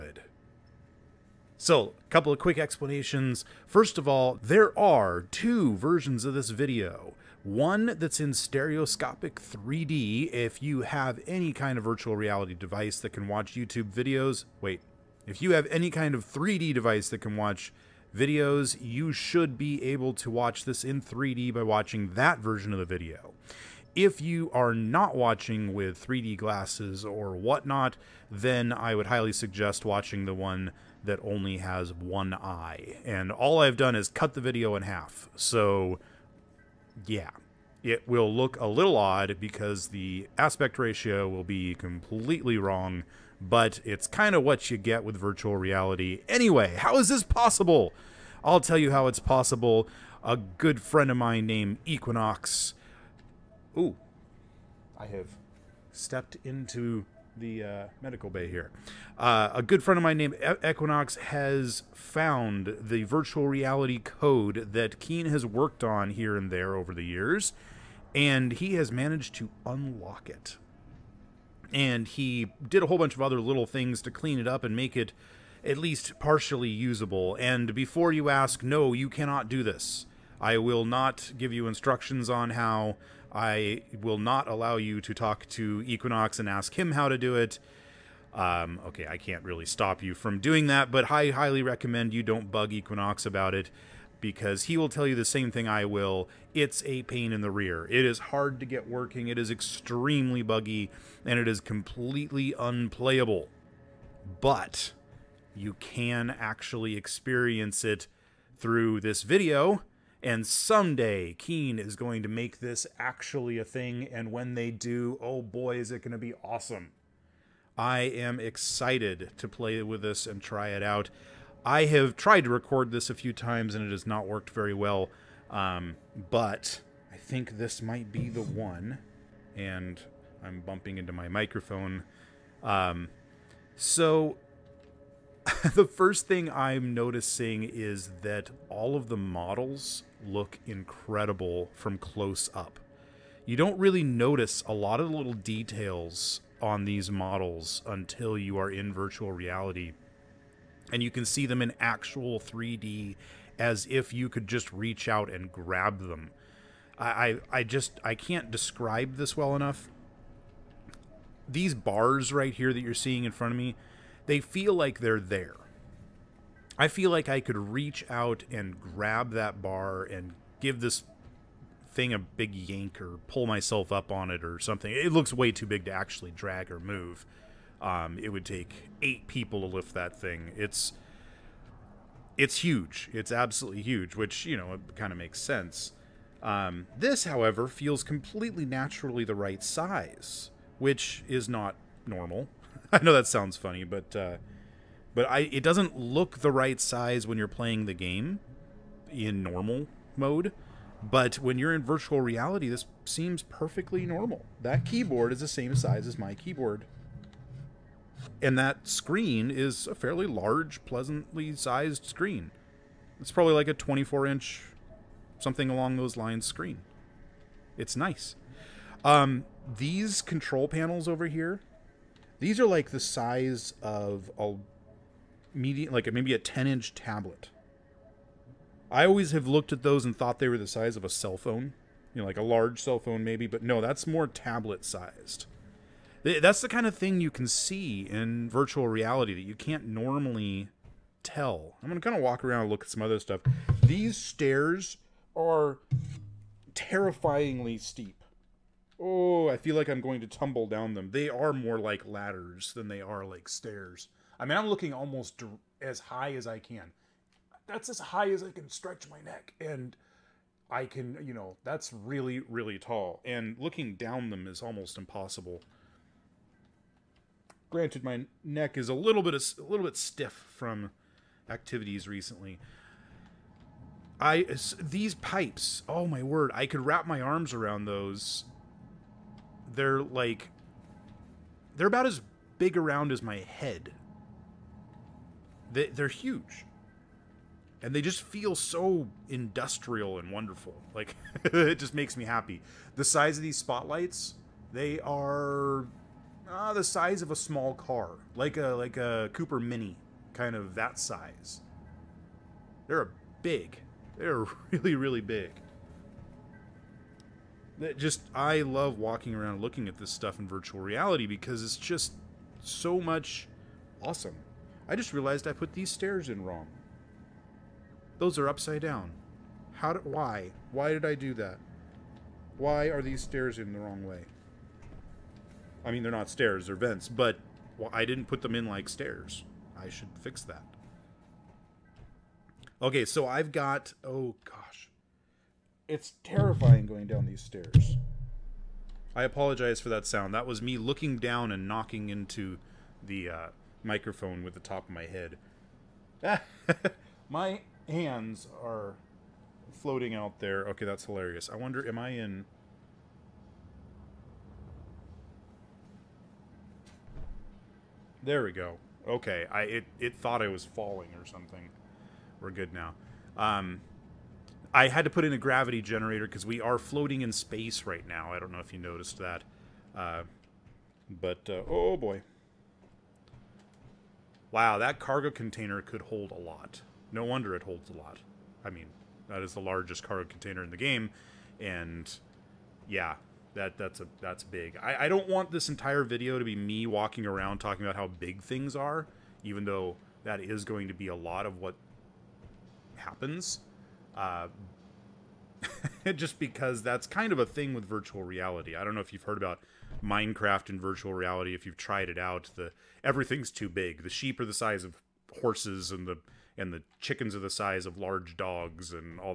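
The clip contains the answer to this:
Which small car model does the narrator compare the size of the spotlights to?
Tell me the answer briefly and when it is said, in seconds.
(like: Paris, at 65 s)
Cooper Mini, at 299 s.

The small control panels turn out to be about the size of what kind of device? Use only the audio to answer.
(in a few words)
10 inch tablet.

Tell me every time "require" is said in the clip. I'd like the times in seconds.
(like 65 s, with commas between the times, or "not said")
not said.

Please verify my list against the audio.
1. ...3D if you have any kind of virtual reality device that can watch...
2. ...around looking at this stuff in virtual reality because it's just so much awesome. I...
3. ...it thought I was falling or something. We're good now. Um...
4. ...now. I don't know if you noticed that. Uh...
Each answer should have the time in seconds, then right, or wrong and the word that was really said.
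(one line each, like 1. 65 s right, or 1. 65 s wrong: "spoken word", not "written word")
1. 9 s right
2. 309 s right
3. 359 s right
4. 368 s right.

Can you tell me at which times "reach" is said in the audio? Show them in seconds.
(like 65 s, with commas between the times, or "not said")
154 s, 167 s.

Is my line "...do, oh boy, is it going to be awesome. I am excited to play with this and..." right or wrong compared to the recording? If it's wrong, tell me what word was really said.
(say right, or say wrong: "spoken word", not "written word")
right.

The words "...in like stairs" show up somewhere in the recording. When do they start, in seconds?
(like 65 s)
328 s.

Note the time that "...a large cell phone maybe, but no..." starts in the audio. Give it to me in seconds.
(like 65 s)
232 s.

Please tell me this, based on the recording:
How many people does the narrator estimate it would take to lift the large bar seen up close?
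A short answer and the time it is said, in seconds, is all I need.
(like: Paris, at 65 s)
8, at 179 s.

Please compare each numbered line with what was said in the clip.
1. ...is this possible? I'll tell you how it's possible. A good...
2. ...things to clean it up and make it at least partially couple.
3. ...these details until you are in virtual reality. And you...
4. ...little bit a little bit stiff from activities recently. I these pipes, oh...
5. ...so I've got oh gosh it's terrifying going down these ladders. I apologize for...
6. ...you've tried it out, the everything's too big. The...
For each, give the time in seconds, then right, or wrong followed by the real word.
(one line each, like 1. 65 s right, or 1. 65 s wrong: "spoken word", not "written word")
1. 46 s right
2. 73 s wrong: "usable", not "couple"
3. 146 s wrong: "models", not "details"
4. 268 s right
5. 333 s wrong: "stairs", not "ladders"
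6. 401 s right.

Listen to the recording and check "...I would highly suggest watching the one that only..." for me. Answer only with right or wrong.
right.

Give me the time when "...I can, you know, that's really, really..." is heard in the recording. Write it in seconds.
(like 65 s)
260 s.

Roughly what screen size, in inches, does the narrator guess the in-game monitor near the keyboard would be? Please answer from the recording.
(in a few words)
24 inch.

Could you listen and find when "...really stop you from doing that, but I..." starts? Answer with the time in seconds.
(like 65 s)
89 s.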